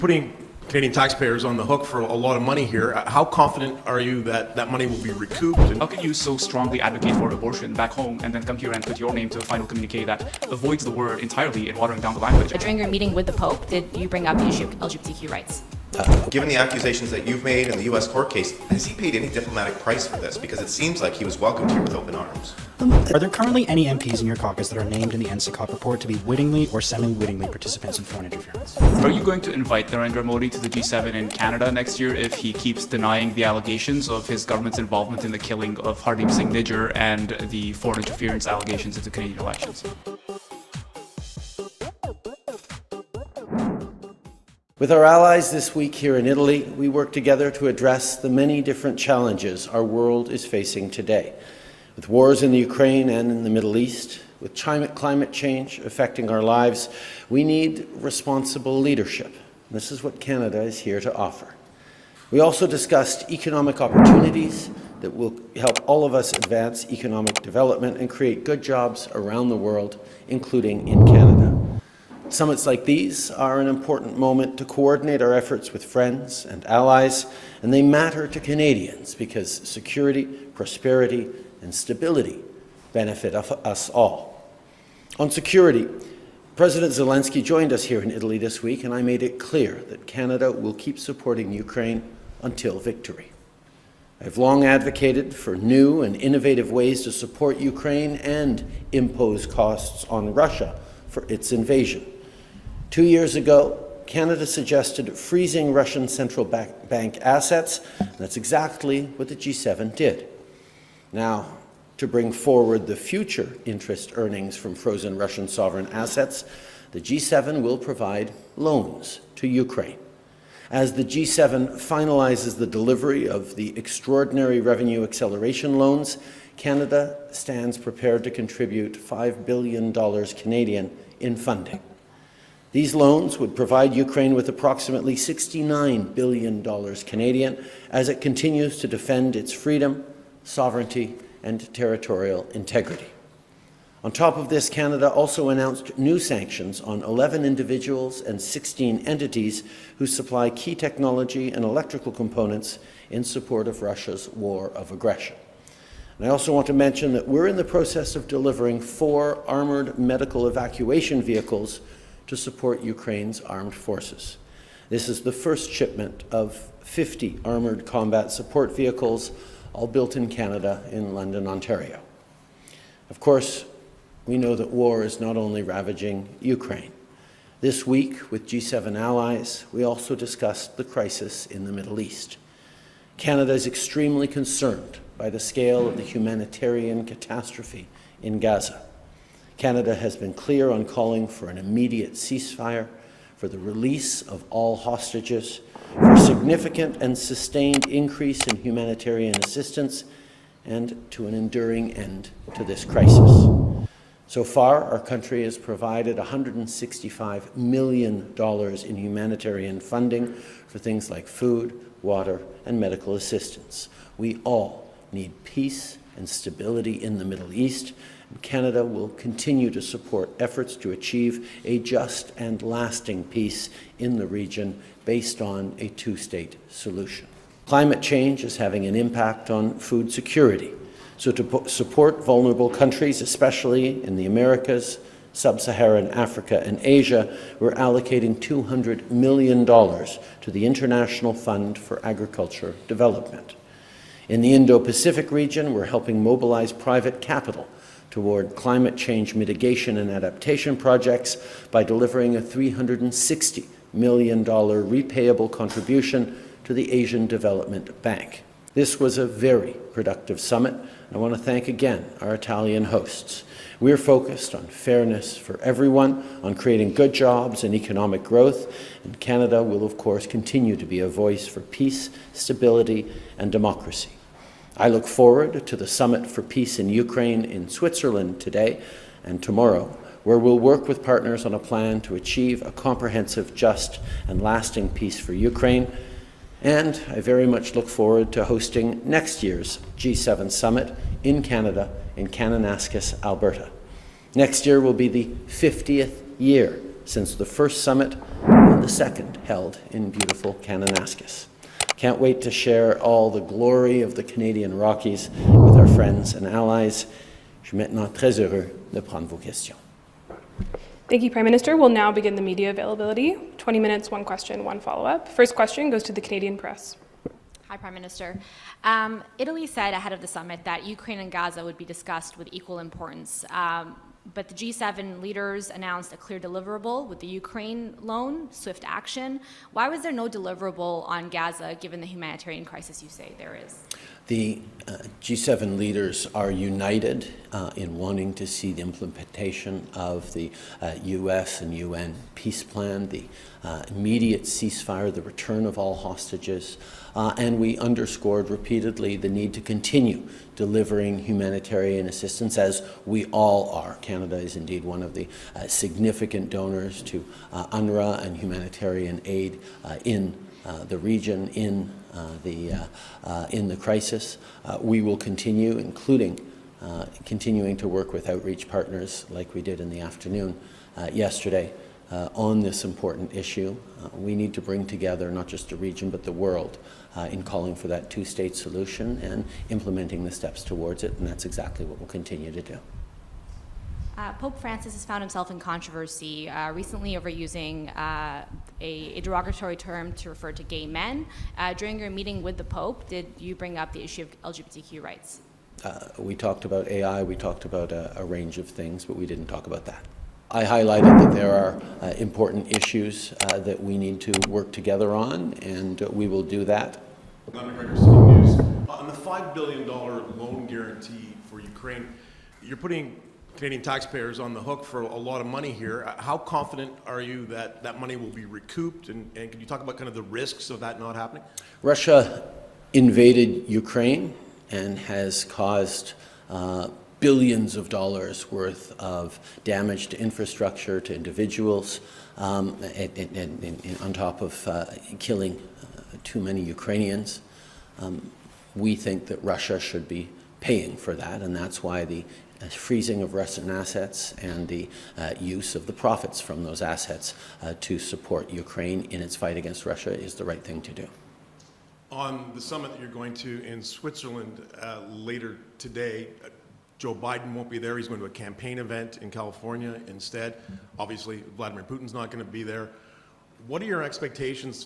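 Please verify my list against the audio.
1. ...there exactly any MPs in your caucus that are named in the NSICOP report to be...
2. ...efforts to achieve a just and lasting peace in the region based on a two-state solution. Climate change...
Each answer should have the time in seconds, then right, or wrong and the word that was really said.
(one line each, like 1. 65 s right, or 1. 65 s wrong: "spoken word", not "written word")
1. 23 s wrong: "currently", not "exactly"
2. 220 s right.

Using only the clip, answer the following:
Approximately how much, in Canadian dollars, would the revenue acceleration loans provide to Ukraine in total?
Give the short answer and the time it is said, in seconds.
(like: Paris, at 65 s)
$69 billion, at 135 s.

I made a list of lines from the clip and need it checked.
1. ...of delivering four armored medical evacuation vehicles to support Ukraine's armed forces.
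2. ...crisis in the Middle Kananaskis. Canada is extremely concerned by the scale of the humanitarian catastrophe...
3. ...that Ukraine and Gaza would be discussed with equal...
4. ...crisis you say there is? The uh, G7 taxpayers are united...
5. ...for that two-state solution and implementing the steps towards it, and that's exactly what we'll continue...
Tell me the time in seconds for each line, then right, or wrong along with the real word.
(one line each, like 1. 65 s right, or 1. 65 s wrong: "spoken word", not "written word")
1. 158 s right
2. 180 s wrong: "East", not "Kananaskis"
3. 320 s right
4. 332 s wrong: "leaders", not "taxpayers"
5. 377 s right.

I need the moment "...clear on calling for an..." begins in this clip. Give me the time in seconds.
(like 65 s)
190 s.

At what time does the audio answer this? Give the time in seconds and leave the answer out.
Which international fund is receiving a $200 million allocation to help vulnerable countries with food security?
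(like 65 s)
240 s.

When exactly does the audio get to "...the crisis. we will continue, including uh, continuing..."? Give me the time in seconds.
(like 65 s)
363 s.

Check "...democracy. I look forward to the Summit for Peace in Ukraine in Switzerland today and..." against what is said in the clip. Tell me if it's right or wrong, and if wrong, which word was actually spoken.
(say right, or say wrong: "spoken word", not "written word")
right.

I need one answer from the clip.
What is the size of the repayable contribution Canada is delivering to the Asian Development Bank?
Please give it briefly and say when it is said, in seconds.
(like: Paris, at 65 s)
$360 million, at 252 s.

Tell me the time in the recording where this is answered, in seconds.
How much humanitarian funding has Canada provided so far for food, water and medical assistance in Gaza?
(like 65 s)
206 s.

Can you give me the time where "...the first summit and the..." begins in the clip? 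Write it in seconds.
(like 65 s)
297 s.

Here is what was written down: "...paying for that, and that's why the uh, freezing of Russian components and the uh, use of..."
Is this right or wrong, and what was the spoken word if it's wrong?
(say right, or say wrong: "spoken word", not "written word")
wrong: "assets", not "components".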